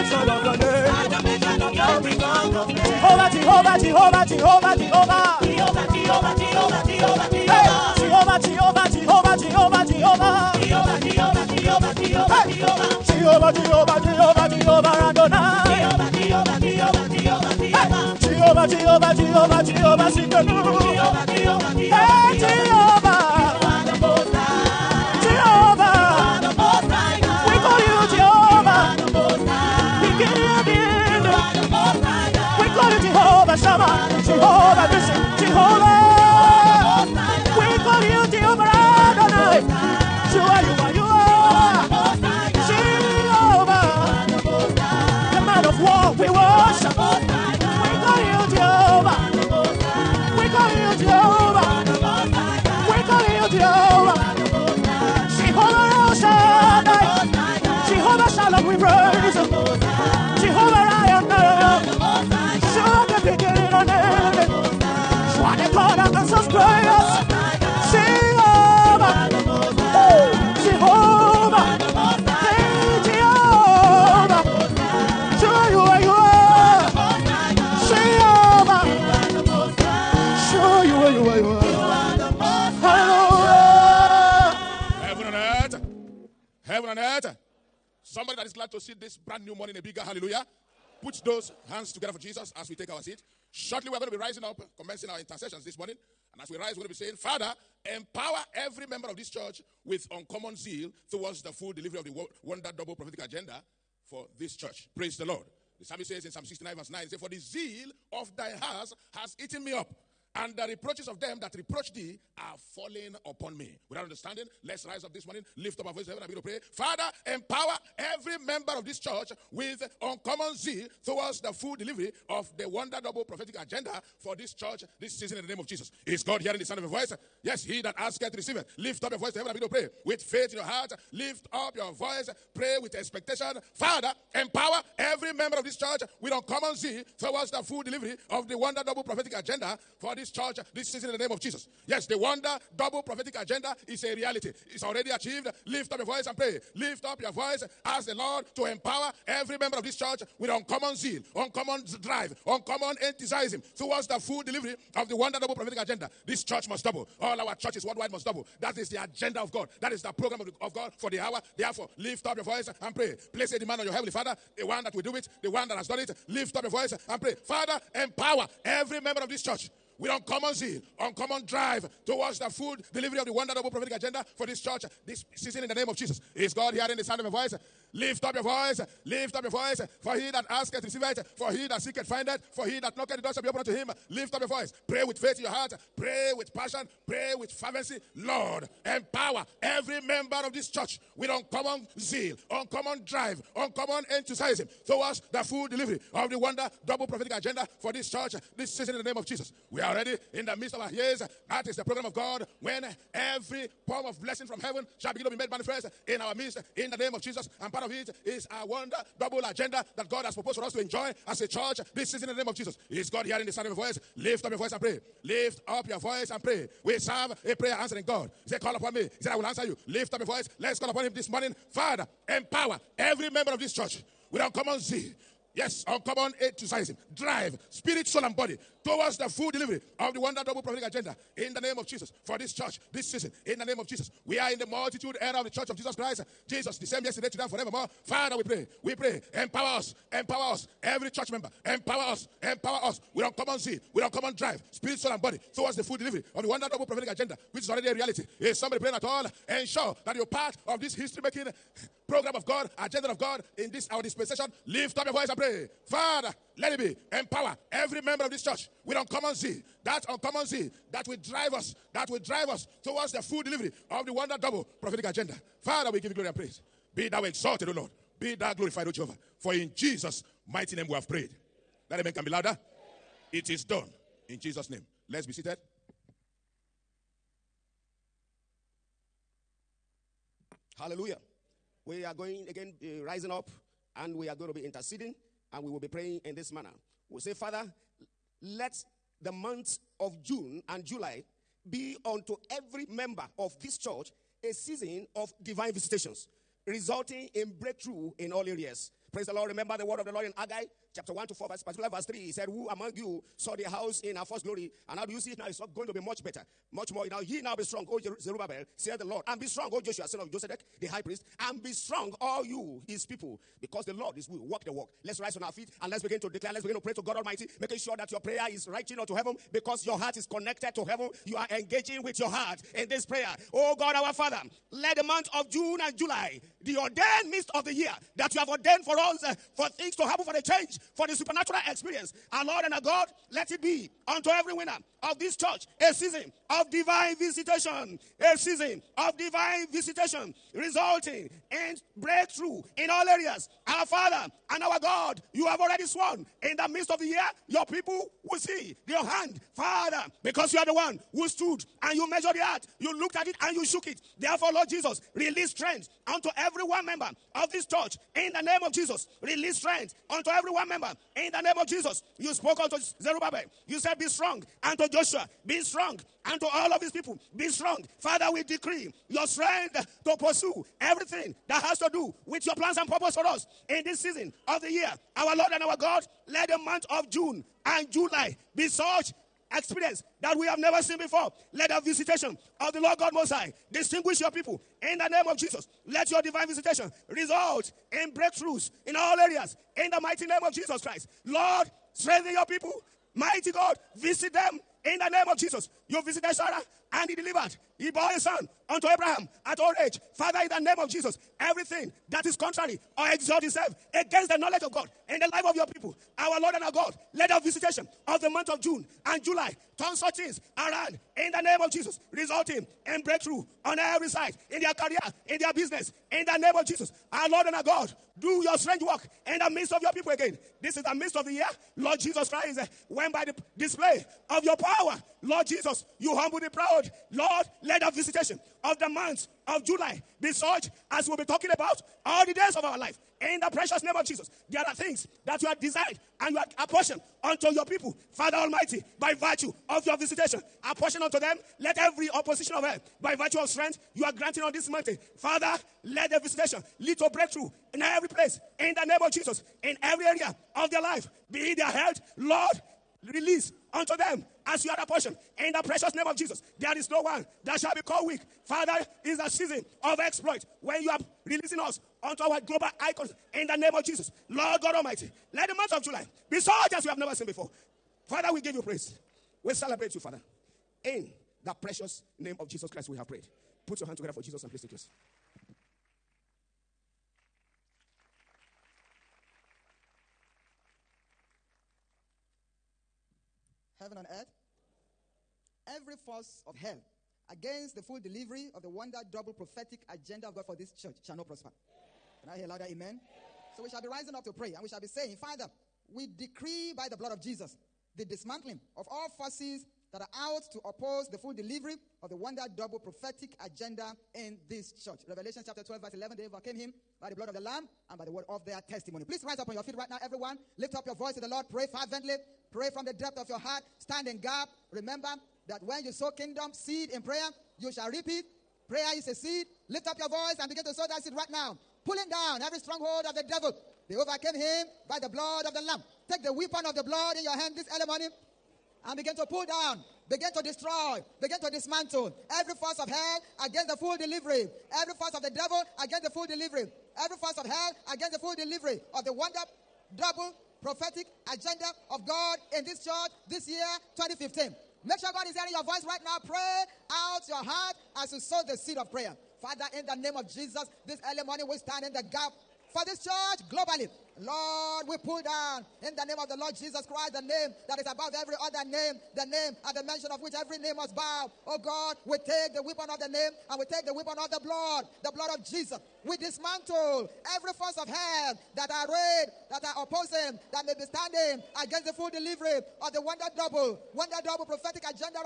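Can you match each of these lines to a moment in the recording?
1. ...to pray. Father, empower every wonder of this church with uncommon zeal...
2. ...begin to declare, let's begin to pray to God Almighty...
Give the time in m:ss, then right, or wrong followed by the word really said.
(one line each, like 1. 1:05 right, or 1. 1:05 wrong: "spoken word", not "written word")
1. 1:56 wrong: "member", not "wonder"
2. 5:16 right.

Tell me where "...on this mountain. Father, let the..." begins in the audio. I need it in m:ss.
7:24.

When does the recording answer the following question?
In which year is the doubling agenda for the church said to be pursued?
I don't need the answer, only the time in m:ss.
9:03.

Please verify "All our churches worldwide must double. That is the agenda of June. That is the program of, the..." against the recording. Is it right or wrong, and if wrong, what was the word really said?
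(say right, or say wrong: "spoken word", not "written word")
wrong: "God", not "June".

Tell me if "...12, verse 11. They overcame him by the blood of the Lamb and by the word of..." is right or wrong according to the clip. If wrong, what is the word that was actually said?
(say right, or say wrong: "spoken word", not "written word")
right.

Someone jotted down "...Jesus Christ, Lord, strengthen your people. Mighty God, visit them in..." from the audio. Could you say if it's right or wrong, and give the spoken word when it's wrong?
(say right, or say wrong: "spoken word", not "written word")
right.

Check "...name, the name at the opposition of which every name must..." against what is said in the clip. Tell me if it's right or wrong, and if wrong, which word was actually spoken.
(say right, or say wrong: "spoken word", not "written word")
wrong: "mention", not "opposition".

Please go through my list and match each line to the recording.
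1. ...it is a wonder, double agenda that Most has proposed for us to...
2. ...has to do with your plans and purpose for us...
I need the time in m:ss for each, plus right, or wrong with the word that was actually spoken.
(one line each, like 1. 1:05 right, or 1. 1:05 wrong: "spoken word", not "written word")
1. 3:27 wrong: "God", not "Most"
2. 6:11 right.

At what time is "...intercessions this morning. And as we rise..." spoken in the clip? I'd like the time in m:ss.
1:35.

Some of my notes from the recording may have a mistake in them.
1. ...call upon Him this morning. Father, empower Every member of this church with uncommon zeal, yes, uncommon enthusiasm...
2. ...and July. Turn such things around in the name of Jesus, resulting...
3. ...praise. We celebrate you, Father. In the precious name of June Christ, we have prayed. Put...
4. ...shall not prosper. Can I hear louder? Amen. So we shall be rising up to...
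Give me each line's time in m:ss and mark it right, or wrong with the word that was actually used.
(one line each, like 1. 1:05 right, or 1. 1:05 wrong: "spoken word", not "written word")
1. 3:40 right
2. 6:49 right
3. 7:48 wrong: "Jesus", not "June"
4. 8:11 right.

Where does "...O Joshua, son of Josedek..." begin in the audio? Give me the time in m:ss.
5:09.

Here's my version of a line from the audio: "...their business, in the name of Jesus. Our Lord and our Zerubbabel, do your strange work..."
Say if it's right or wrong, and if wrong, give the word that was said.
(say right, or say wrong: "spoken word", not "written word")
wrong: "God", not "Zerubbabel".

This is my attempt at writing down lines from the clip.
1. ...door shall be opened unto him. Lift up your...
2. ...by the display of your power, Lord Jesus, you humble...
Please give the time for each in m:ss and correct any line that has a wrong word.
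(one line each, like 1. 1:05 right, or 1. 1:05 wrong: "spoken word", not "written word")
1. 3:03 right
2. 7:03 right.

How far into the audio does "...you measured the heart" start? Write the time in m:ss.
5:51.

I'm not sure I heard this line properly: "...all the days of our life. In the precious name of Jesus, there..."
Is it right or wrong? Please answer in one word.
right.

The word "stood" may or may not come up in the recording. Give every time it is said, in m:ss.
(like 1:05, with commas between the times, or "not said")
5:51.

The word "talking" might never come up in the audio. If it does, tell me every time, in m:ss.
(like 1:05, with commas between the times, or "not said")
7:11.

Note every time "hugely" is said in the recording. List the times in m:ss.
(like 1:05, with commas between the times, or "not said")
not said.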